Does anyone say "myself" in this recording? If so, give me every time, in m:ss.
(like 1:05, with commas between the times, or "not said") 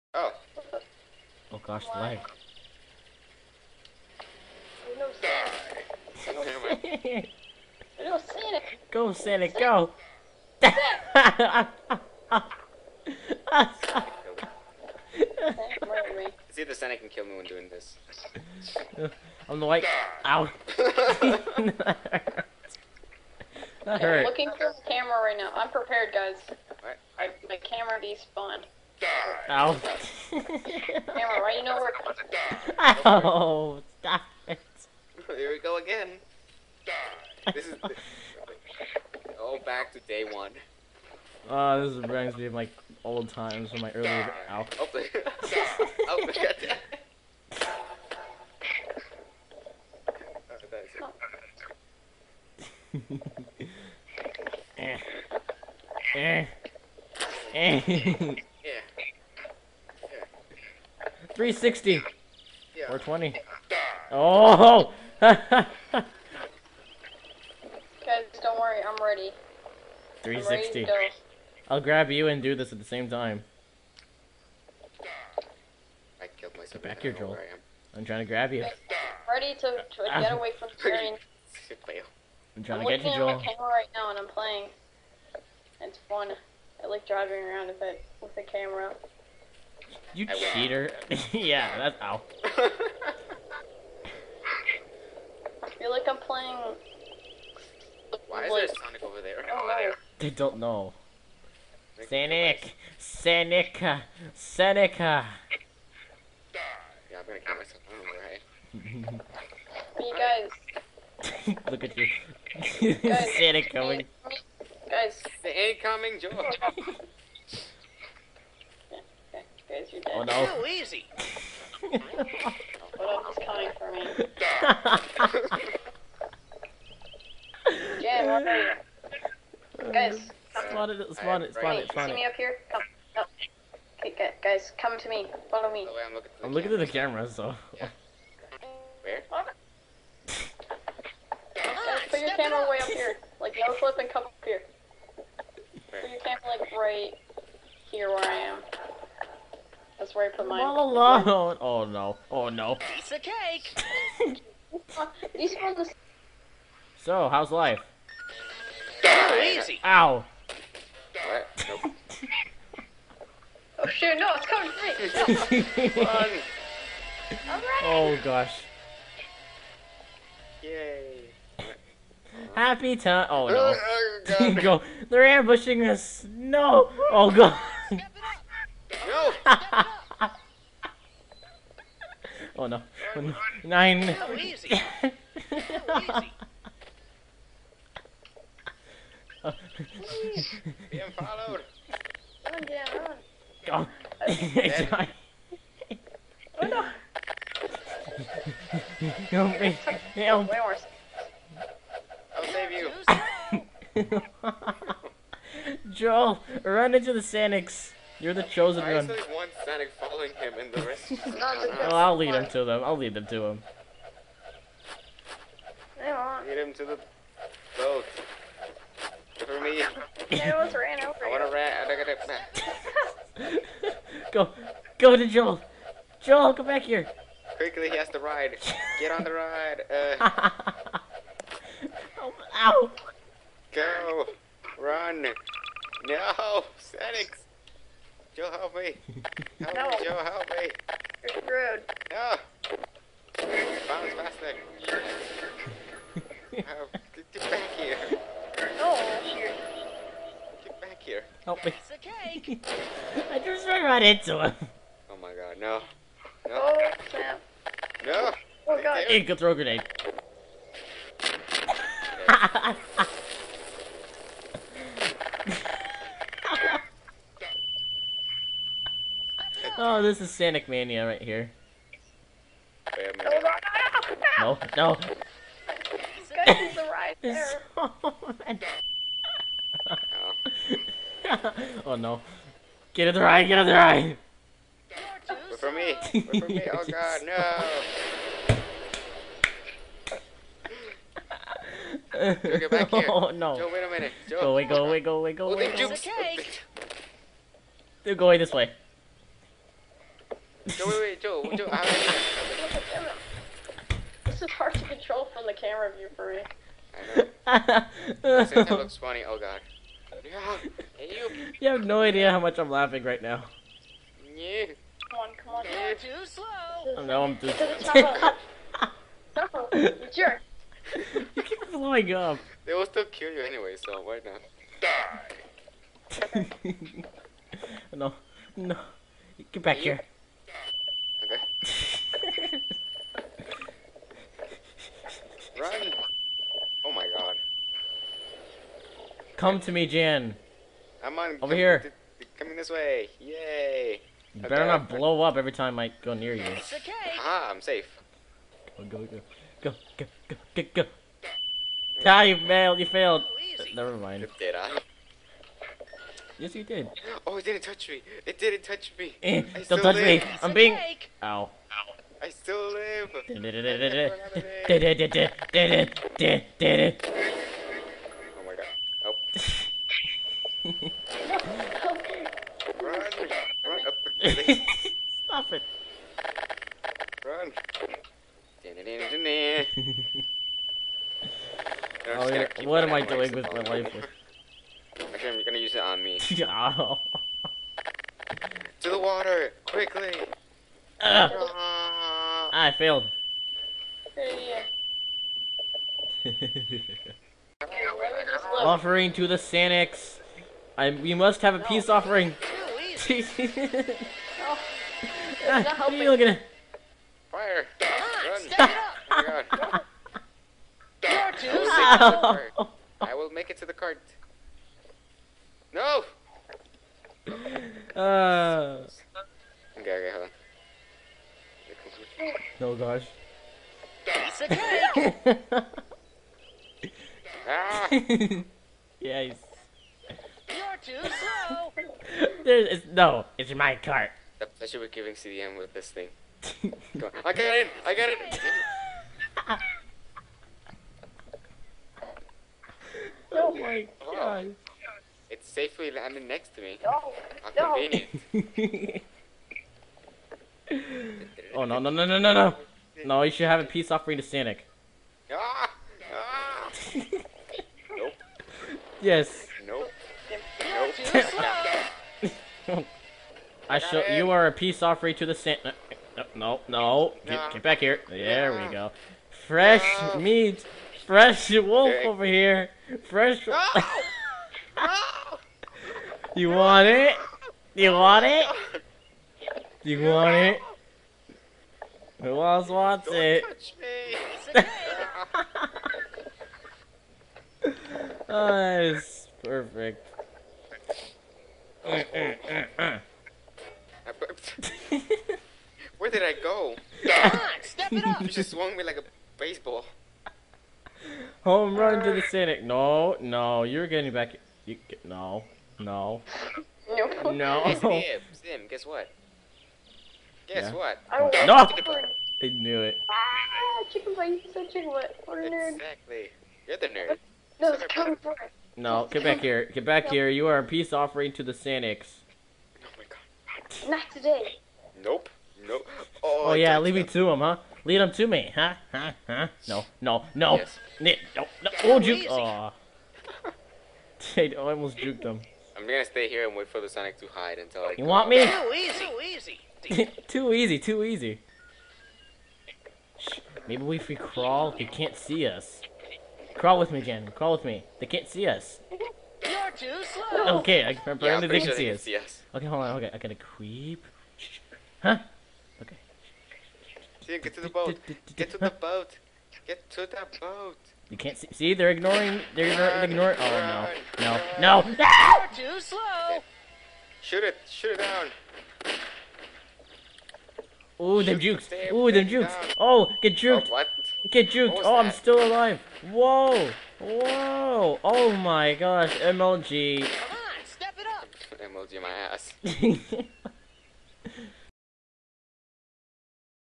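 1:16, 1:47.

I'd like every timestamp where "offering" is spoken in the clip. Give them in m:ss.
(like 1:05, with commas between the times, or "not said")
6:38, 7:33, 7:44, 8:40.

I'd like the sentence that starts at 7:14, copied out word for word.
I pleasure you we're giving CDM with this thing.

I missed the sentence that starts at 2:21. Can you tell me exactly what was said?
Guys, put your camera way up here.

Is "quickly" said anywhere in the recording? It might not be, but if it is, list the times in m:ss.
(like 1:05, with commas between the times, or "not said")
3:47, 6:29.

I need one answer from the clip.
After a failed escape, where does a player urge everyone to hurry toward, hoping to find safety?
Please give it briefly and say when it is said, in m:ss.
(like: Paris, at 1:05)
the water, at 6:28.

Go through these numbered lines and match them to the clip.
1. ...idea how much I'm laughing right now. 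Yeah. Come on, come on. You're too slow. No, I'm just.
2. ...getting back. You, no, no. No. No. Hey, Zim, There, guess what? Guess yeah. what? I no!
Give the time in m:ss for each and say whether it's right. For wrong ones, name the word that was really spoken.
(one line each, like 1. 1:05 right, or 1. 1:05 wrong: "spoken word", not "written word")
1. 5:12 right
2. 8:23 wrong: "Zim", not "There".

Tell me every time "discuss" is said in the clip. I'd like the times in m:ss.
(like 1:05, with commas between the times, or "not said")
not said.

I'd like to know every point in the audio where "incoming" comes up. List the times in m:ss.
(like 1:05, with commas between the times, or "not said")
1:55.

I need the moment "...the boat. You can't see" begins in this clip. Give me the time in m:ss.
9:20.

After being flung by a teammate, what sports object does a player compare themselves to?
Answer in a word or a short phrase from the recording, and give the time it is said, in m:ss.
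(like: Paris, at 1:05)
a baseball, at 8:18.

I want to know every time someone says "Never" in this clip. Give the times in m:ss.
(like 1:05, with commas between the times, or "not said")
0:30, 5:53.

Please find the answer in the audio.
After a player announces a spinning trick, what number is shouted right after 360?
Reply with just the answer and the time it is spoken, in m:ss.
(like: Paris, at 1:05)
420, at 1:02.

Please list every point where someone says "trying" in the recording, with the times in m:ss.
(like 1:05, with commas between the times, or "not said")
1:18, 1:22.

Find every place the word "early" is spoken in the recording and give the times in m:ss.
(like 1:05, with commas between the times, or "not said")
0:43.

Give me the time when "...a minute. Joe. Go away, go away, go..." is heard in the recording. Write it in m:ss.
4:53.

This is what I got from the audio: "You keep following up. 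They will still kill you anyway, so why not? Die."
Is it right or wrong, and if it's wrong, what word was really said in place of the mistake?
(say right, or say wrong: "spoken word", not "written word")
wrong: "blowing", not "following".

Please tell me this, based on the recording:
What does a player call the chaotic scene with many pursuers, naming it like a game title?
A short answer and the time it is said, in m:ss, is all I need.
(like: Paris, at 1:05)
Sanic Mania, at 4:30.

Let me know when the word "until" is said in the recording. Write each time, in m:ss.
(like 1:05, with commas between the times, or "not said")
8:57.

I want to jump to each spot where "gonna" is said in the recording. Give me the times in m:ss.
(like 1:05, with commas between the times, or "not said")
1:47, 6:25, 8:55.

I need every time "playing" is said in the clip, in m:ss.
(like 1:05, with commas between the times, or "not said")
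1:24, 1:36.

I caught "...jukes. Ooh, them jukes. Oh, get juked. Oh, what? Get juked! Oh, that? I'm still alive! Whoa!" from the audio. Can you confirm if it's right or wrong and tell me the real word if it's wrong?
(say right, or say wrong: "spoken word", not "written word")
right.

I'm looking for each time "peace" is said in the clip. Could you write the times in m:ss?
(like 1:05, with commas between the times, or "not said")
7:33, 7:44, 8:40.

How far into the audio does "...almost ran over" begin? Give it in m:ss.
3:40.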